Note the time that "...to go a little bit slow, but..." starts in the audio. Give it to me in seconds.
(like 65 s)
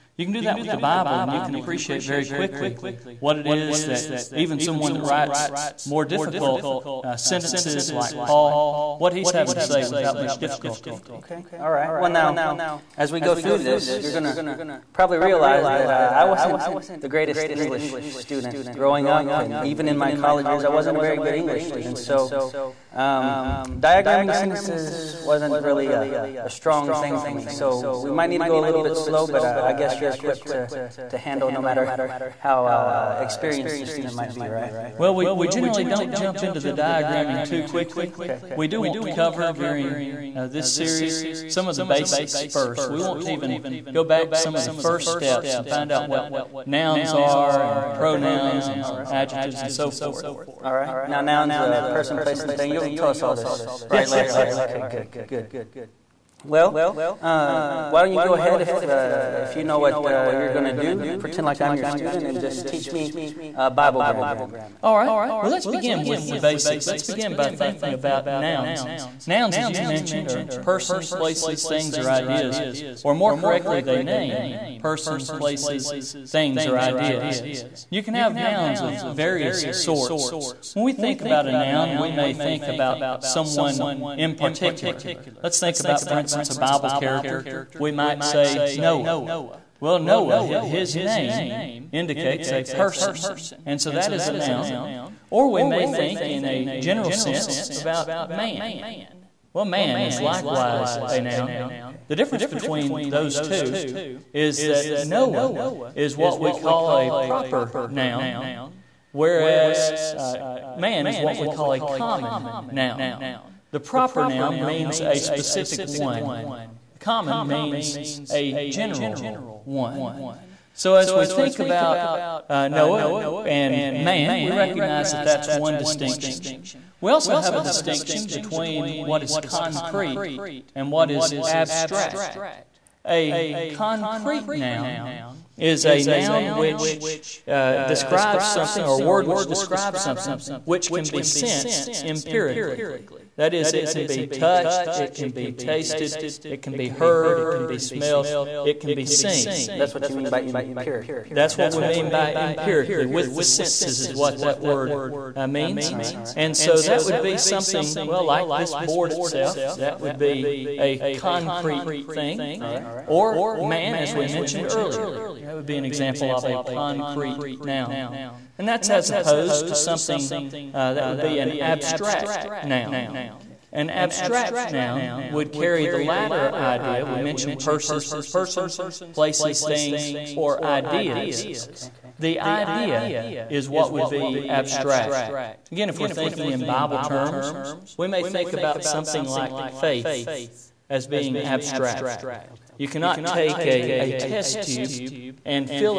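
28 s.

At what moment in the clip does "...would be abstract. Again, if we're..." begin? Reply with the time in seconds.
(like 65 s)
183 s.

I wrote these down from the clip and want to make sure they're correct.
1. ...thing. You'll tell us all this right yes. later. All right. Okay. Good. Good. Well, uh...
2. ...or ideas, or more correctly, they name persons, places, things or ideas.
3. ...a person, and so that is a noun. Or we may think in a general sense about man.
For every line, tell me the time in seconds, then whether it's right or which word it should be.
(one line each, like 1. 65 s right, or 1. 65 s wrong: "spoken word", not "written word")
1. 52 s right
2. 71 s right
3. 92 s right.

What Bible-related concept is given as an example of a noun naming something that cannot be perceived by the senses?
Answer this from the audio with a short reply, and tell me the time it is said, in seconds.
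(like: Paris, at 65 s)
faith, at 189 s.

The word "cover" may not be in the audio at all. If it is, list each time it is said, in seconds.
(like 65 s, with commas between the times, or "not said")
39 s.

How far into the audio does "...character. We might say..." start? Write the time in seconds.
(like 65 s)
86 s.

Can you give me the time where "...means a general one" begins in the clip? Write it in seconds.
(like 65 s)
117 s.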